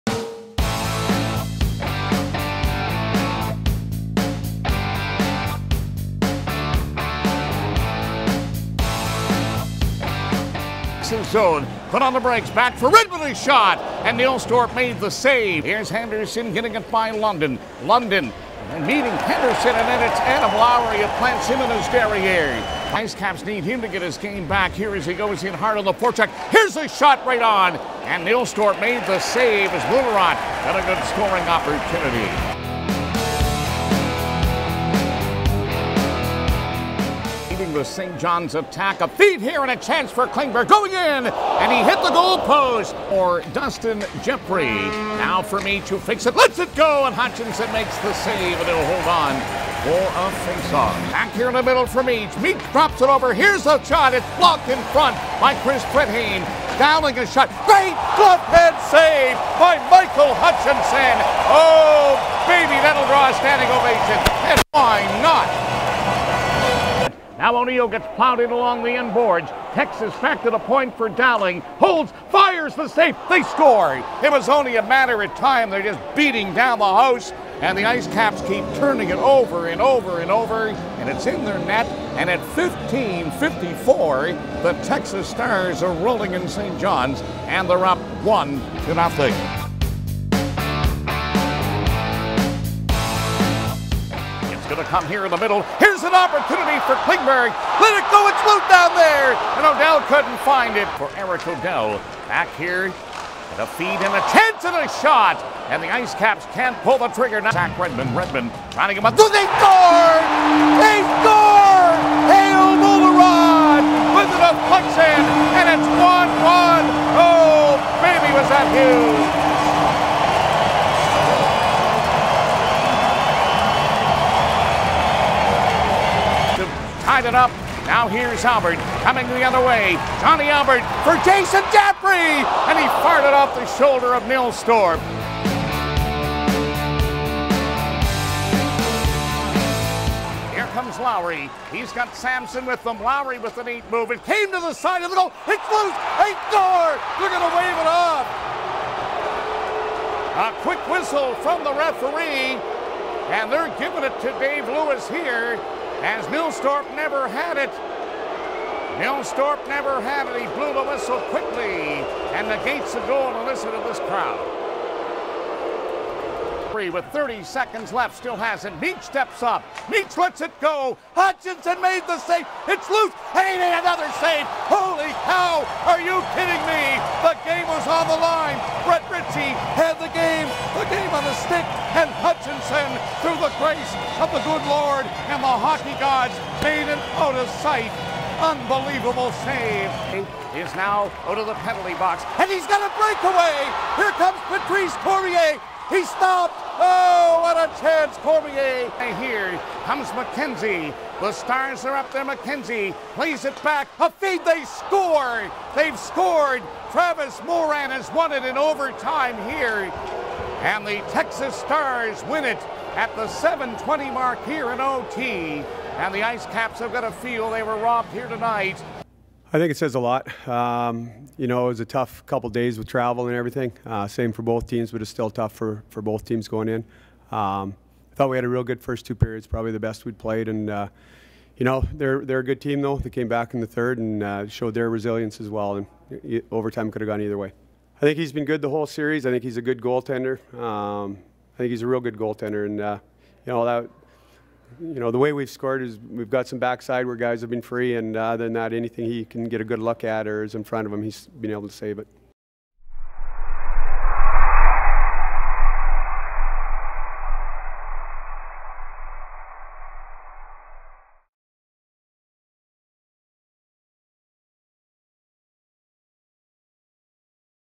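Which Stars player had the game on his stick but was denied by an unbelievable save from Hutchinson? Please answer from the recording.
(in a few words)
Brett Ritchie.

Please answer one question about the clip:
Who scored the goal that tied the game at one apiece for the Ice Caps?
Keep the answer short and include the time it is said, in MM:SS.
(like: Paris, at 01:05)
Kael Mouillierat, at 01:52.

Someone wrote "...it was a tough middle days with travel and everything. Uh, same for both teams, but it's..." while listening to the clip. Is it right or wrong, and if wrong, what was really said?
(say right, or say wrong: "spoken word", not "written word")
wrong: "couple", not "middle".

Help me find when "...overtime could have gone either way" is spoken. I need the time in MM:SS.
03:56.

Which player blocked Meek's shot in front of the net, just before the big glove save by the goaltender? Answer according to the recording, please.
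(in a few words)
Chris Brittain.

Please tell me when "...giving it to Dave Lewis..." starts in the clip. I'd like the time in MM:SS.
02:33.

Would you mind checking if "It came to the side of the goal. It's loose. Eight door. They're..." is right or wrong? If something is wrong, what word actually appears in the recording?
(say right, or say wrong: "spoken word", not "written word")
right.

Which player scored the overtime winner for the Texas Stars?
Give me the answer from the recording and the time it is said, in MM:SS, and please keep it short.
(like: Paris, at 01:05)
Travis Morin, at 03:26.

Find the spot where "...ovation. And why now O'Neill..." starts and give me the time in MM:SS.
01:03.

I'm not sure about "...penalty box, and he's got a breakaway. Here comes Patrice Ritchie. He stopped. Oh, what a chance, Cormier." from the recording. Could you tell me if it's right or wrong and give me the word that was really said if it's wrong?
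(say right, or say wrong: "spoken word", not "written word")
wrong: "Cormier", not "Ritchie".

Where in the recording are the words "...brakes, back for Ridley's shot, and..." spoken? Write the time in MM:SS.
00:12.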